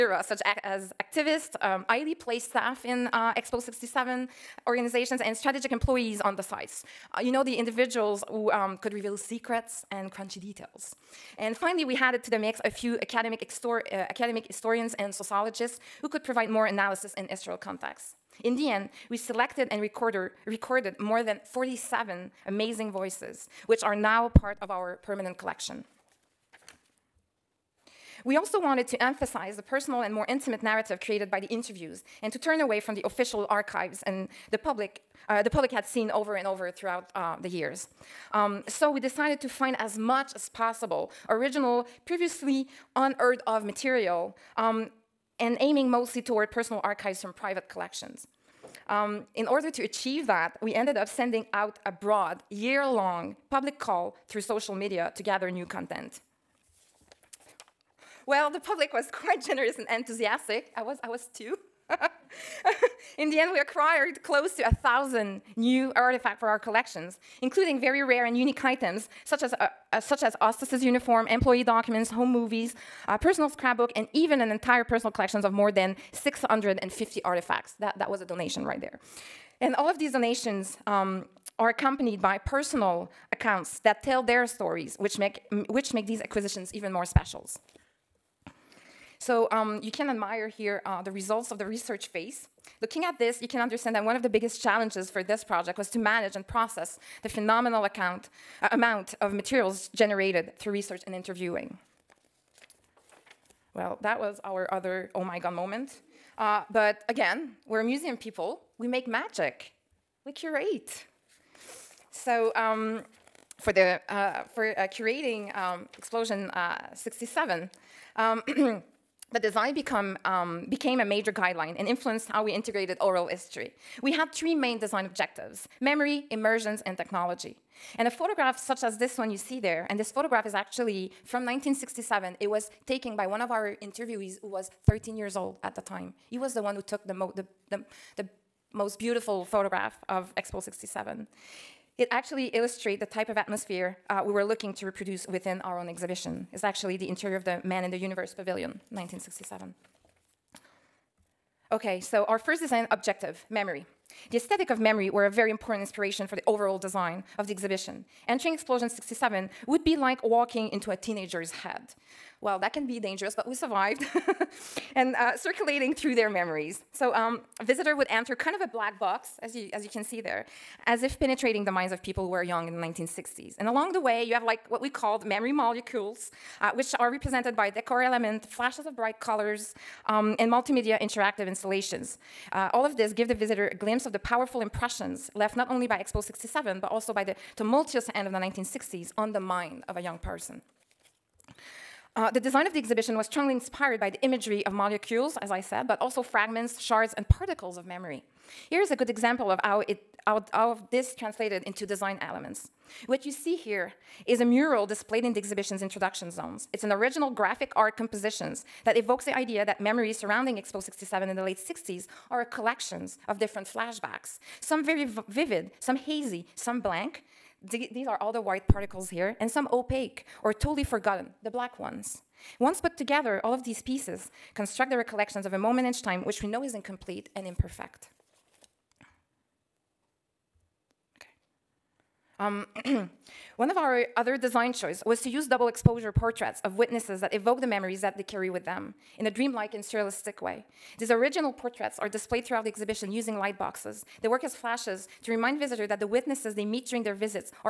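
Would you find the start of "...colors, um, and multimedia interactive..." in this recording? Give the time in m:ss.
2:59.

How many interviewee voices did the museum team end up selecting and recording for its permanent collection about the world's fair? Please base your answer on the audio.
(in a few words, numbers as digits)
47.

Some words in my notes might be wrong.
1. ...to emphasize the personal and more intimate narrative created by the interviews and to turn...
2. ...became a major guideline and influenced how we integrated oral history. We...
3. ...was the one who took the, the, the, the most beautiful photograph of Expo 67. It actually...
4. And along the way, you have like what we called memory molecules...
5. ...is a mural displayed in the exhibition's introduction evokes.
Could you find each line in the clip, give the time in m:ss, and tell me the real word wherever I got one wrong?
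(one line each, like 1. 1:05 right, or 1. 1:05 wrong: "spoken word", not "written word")
1. 0:28 right
2. 2:00 right
3. 2:16 right
4. 2:53 right
5. 3:24 wrong: "zones", not "evokes".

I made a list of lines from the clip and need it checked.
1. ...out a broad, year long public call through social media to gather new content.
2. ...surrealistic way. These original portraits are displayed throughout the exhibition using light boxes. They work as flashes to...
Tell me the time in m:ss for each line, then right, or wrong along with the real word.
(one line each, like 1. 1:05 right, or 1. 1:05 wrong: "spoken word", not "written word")
1. 0:51 right
2. 3:59 right.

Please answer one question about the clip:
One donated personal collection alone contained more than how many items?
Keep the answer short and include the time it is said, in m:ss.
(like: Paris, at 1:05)
650, at 1:15.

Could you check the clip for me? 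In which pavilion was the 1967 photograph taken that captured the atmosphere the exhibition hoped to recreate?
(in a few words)
Man in the Universe Pavilion.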